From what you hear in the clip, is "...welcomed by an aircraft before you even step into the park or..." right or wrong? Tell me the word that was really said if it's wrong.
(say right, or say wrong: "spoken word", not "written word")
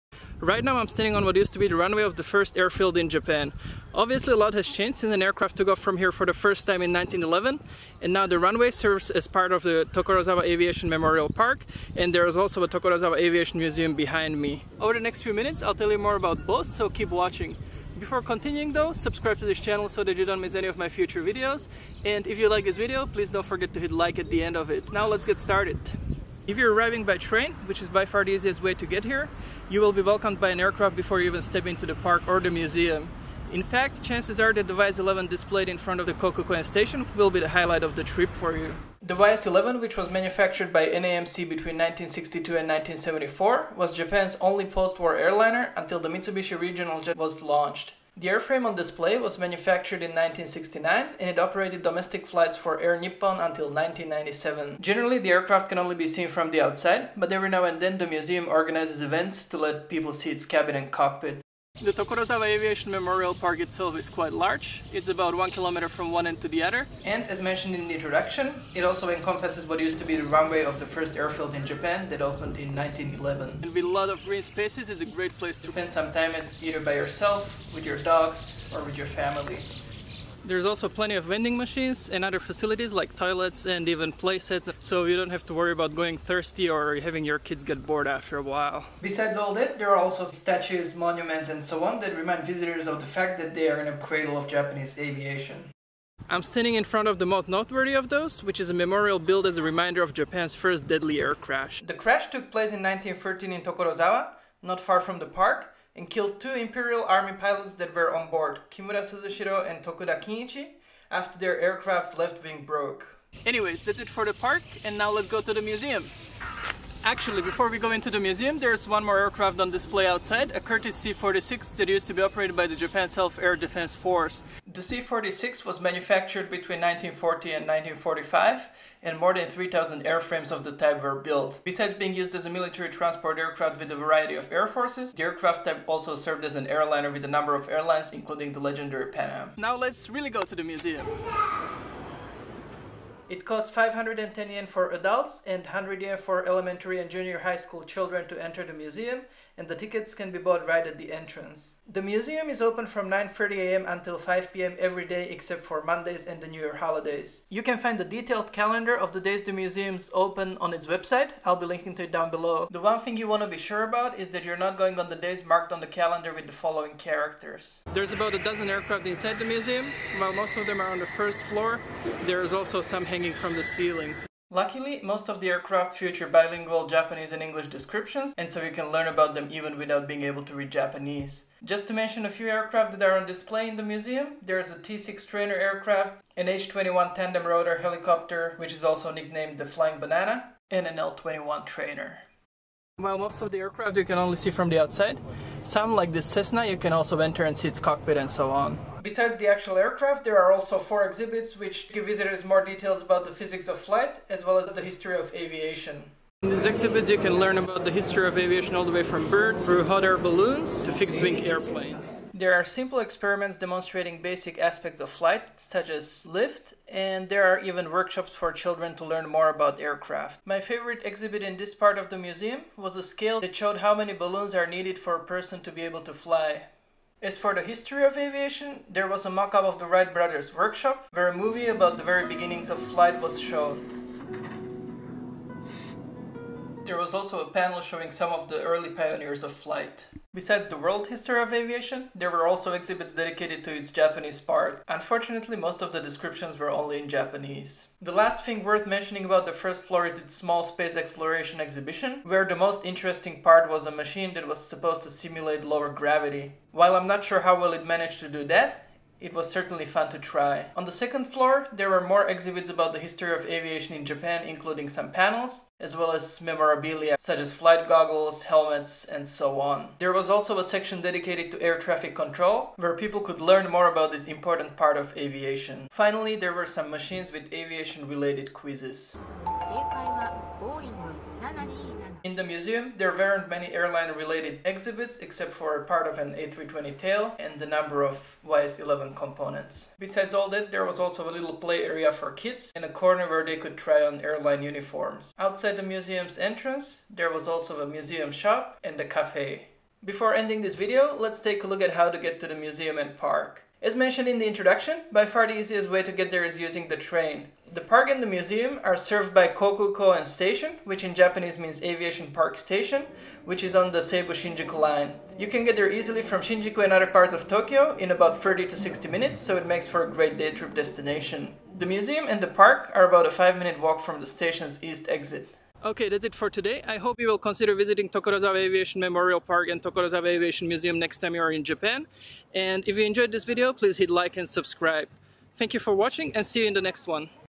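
right.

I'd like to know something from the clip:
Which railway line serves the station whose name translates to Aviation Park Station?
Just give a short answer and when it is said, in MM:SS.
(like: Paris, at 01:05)
Seibu Shinjuku line, at 05:14.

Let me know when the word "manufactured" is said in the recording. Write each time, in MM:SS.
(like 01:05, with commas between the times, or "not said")
00:40, 00:49, 02:05.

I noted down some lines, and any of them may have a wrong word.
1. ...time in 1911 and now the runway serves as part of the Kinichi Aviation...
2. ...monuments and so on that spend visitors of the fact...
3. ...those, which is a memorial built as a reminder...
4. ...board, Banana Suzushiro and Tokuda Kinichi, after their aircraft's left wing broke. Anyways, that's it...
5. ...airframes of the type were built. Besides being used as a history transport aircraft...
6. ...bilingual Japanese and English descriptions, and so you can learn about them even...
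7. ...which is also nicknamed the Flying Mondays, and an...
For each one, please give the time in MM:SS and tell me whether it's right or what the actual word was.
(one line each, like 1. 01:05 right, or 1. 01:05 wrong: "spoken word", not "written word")
1. 00:06 wrong: "Tokorozawa", not "Kinichi"
2. 01:30 wrong: "remind", not "spend"
3. 01:38 right
4. 01:48 wrong: "Kimura", not "Banana"
5. 02:10 wrong: "military", not "history"
6. 02:56 right
7. 03:08 wrong: "Banana", not "Mondays".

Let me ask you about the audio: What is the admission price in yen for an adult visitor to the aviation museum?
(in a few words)
510 yen.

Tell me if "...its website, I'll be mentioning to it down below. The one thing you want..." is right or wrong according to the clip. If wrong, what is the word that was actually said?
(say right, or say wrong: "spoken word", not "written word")
wrong: "linking", not "mentioning".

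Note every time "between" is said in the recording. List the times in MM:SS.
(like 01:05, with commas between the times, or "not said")
00:41, 02:06.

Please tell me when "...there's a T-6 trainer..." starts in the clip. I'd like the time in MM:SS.
03:04.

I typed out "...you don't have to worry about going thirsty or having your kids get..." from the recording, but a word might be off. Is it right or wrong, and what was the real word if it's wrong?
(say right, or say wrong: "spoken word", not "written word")
right.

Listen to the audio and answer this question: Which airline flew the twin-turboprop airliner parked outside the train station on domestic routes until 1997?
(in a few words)
Air Nippon.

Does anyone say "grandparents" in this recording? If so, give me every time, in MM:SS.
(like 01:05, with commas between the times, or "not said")
not said.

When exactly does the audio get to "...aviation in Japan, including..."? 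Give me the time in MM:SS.
04:23.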